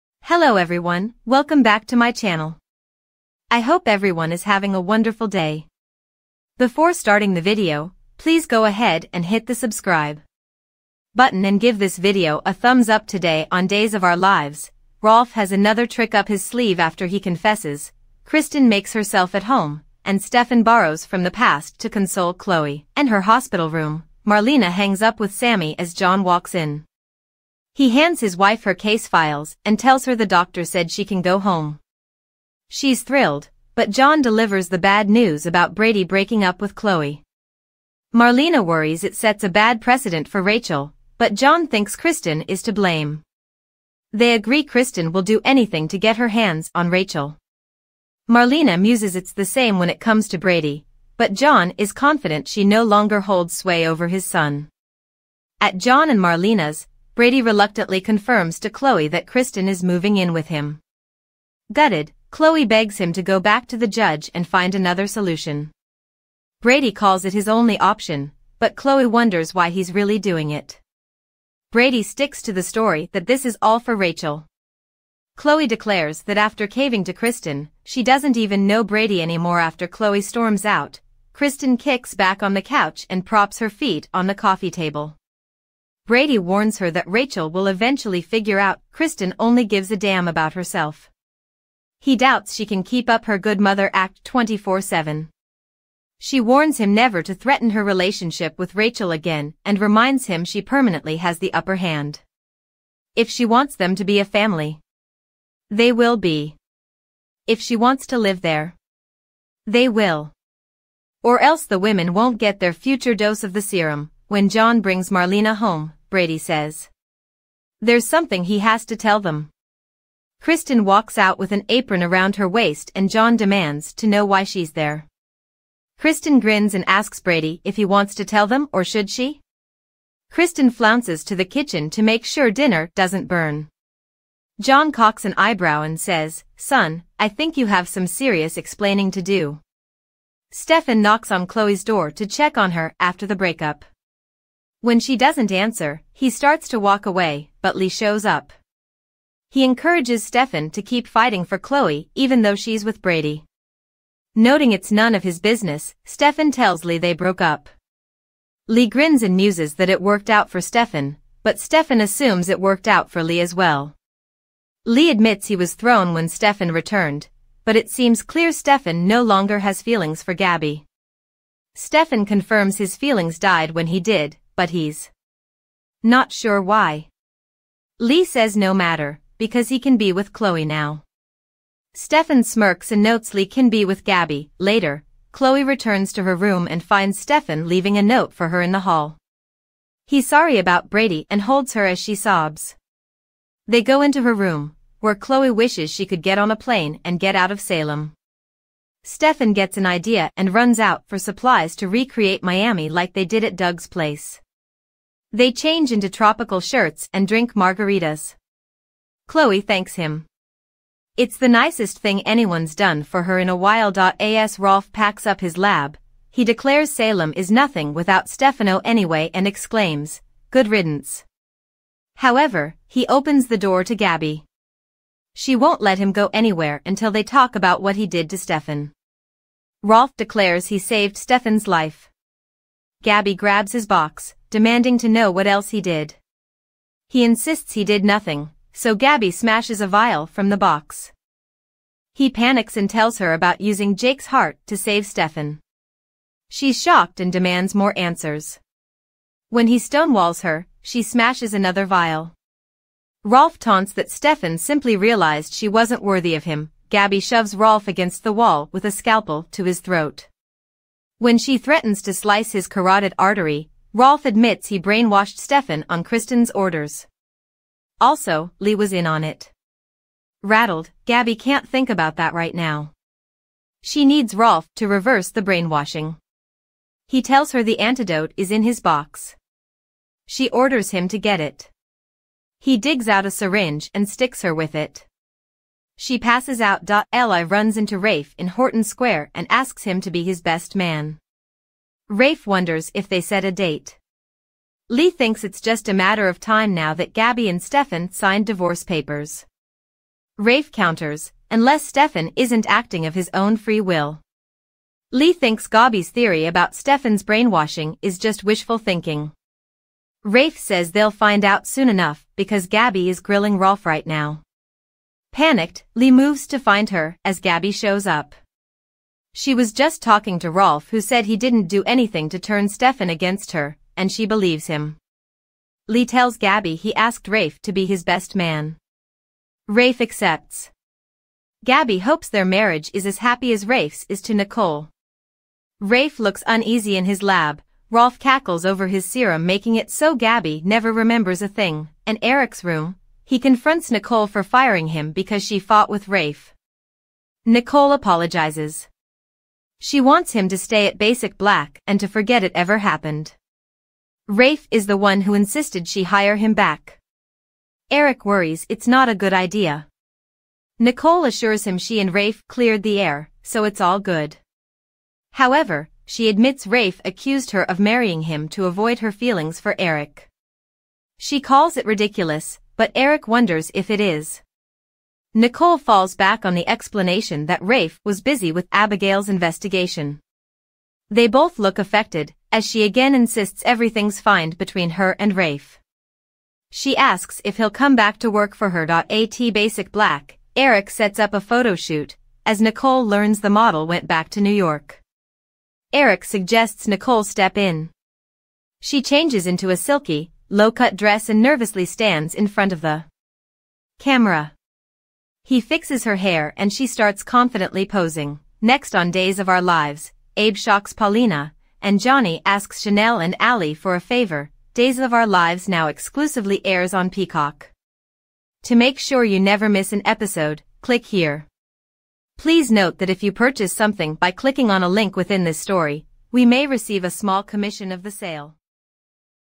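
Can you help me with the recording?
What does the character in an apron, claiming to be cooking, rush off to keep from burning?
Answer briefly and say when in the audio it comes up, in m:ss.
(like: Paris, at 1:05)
dinner, at 2:12.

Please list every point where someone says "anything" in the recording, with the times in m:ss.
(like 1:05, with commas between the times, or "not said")
0:45, 5:21.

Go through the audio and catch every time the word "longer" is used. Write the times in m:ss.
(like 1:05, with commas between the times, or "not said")
0:52, 2:49.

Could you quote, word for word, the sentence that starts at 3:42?
However, he opens the door to Gabi.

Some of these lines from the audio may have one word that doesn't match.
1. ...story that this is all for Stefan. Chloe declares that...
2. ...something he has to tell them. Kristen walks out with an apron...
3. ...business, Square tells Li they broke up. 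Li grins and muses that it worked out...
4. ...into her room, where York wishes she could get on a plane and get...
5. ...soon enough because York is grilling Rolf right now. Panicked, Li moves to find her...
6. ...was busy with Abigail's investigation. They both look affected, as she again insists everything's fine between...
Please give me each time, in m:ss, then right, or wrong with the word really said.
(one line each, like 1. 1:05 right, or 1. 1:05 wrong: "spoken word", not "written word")
1. 1:12 wrong: "Rachel", not "Stefan"
2. 1:58 right
3. 2:35 wrong: "Stefan", not "Square"
4. 3:14 wrong: "Chloe", not "York"
5. 5:11 wrong: "Gabi", not "York"
6. 6:18 right.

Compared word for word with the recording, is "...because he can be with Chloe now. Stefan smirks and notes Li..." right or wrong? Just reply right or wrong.
right.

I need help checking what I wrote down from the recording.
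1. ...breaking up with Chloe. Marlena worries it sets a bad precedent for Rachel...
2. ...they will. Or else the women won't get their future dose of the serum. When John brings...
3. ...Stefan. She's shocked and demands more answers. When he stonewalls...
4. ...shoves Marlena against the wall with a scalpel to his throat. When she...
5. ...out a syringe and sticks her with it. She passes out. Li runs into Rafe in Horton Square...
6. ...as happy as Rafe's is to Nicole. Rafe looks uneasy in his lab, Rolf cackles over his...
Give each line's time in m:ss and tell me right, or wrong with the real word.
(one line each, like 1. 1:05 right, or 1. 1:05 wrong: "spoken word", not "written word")
1. 0:36 right
2. 1:49 right
3. 4:05 right
4. 4:17 wrong: "Rolf", not "Marlena"
5. 4:43 right
6. 5:33 right.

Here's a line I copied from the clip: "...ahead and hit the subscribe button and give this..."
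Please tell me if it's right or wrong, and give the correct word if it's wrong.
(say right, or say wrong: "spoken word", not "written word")
right.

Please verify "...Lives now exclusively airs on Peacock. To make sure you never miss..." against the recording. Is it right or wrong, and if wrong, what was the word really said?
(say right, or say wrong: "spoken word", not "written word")
right.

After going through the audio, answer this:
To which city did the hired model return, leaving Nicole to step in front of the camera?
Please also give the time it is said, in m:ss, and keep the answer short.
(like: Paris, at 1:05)
New York, at 6:34.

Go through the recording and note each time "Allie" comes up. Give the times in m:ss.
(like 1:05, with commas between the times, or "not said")
6:53.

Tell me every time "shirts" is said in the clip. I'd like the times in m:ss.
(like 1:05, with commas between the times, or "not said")
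3:26.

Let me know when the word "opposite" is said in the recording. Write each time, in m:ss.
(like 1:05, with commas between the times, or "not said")
not said.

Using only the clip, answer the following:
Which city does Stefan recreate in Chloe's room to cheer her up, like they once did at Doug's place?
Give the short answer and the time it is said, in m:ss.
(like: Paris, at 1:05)
Miami, at 3:22.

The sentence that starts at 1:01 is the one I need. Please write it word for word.
Gutted, Chloe begs him to go back to the judge and find another solution.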